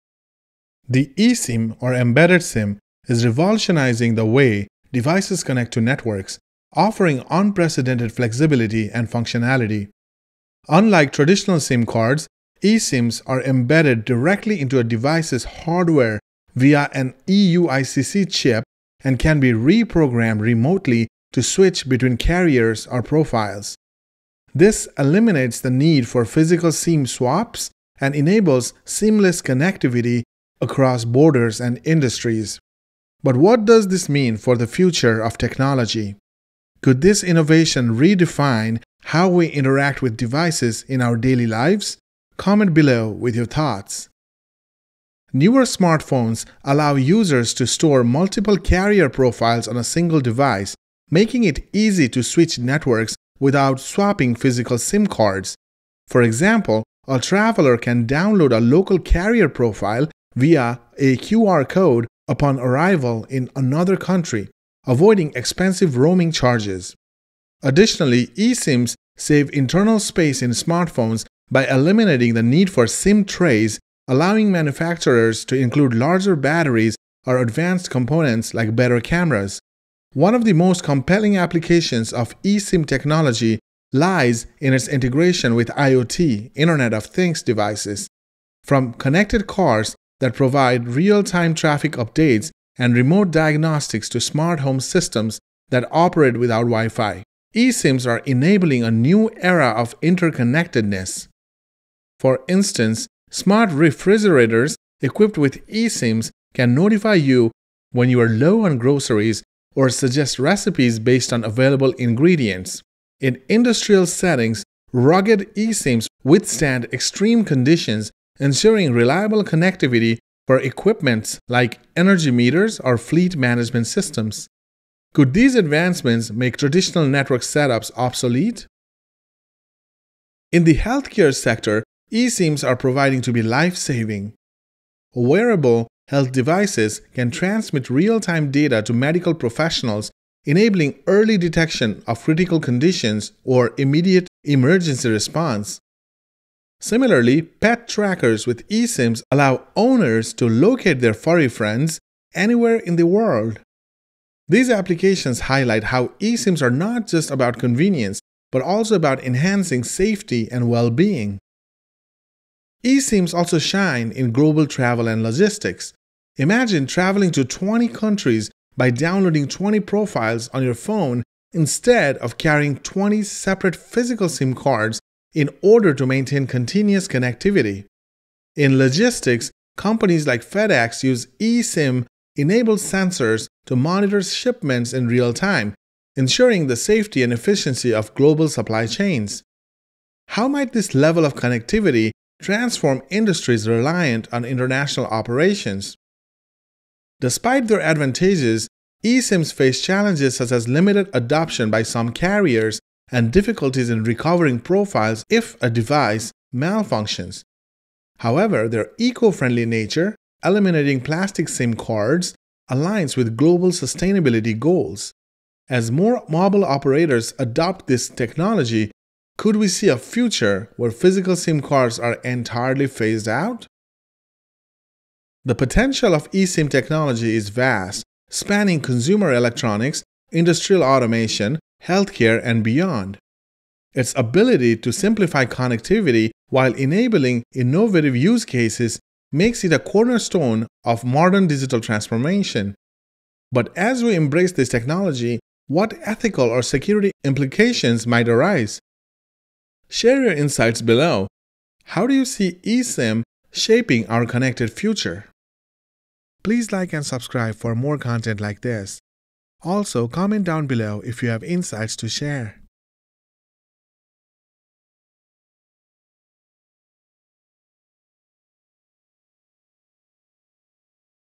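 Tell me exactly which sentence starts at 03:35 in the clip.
As more mobile operators adopt this technology, could we see a future where physical SIM cards are entirely phased out?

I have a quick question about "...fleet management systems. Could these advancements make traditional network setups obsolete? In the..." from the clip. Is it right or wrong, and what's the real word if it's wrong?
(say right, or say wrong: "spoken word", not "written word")
right.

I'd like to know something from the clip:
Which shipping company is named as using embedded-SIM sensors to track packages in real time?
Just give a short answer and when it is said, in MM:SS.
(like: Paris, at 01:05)
FedEx, at 03:00.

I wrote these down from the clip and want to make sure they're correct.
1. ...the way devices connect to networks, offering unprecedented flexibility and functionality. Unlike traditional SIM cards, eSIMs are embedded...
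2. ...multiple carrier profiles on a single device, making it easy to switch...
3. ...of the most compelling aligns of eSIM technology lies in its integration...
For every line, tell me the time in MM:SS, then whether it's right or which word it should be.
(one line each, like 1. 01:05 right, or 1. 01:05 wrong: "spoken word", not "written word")
1. 00:04 right
2. 00:48 right
3. 01:20 wrong: "applications", not "aligns".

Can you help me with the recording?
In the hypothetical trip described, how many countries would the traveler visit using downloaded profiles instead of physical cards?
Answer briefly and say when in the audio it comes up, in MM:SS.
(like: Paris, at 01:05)
20, at 02:47.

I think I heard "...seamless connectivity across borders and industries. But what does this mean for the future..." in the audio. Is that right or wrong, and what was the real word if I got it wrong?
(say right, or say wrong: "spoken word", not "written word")
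right.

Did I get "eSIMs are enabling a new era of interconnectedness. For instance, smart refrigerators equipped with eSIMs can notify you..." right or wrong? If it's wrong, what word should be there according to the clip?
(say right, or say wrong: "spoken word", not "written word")
right.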